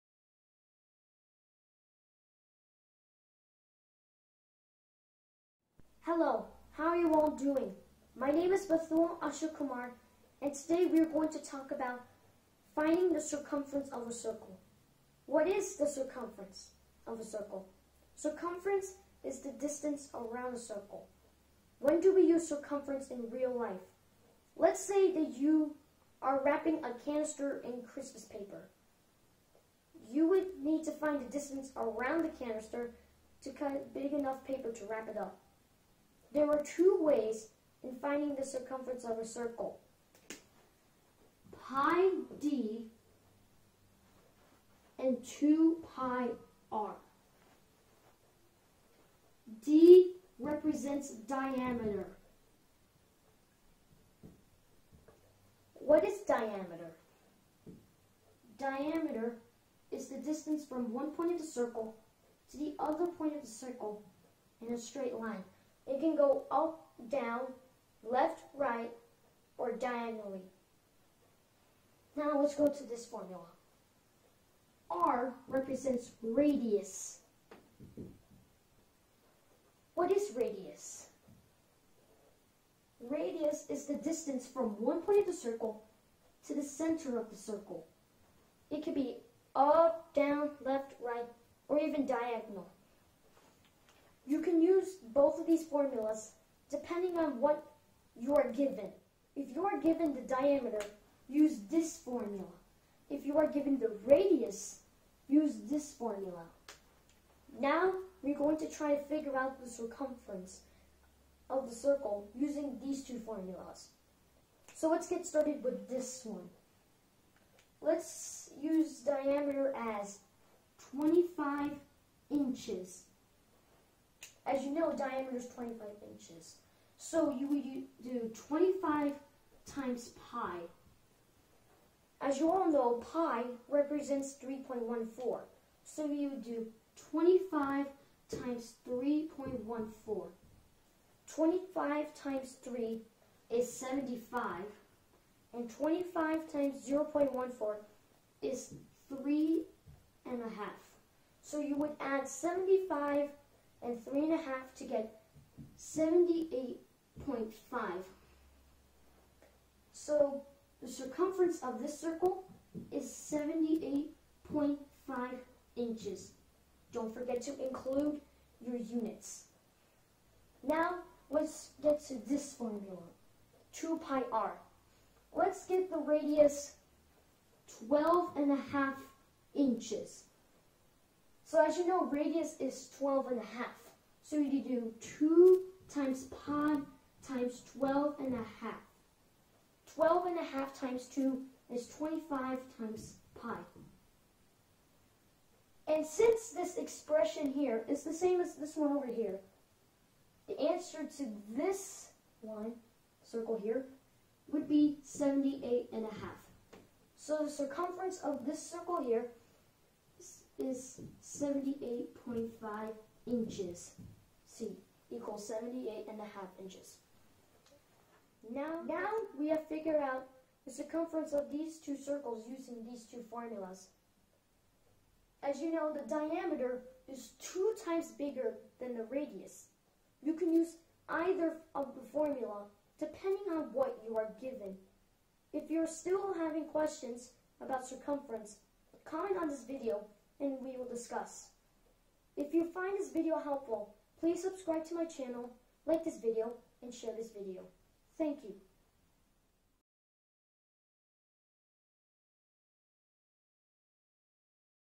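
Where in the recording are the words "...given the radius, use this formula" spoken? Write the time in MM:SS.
01:43.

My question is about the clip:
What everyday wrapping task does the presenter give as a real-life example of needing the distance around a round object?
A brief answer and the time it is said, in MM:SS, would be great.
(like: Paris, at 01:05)
Wrapping a canister in Christmas paper, at 00:26.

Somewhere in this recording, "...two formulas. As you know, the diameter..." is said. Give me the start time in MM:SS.
03:43.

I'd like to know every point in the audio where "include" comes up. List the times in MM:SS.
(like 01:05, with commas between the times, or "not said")
02:47.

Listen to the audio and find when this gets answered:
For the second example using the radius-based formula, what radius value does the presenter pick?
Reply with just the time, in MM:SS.
02:57.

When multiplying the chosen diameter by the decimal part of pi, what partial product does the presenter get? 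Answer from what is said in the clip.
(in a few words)
3.5.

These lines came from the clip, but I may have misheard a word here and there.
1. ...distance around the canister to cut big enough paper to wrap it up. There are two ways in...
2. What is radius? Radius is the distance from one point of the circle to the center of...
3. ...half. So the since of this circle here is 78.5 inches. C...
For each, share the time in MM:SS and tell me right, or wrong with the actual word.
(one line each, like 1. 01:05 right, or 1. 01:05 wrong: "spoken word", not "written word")
1. 00:31 right
2. 01:19 right
3. 03:26 wrong: "circumference", not "since".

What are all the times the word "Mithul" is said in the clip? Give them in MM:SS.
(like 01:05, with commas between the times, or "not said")
00:08.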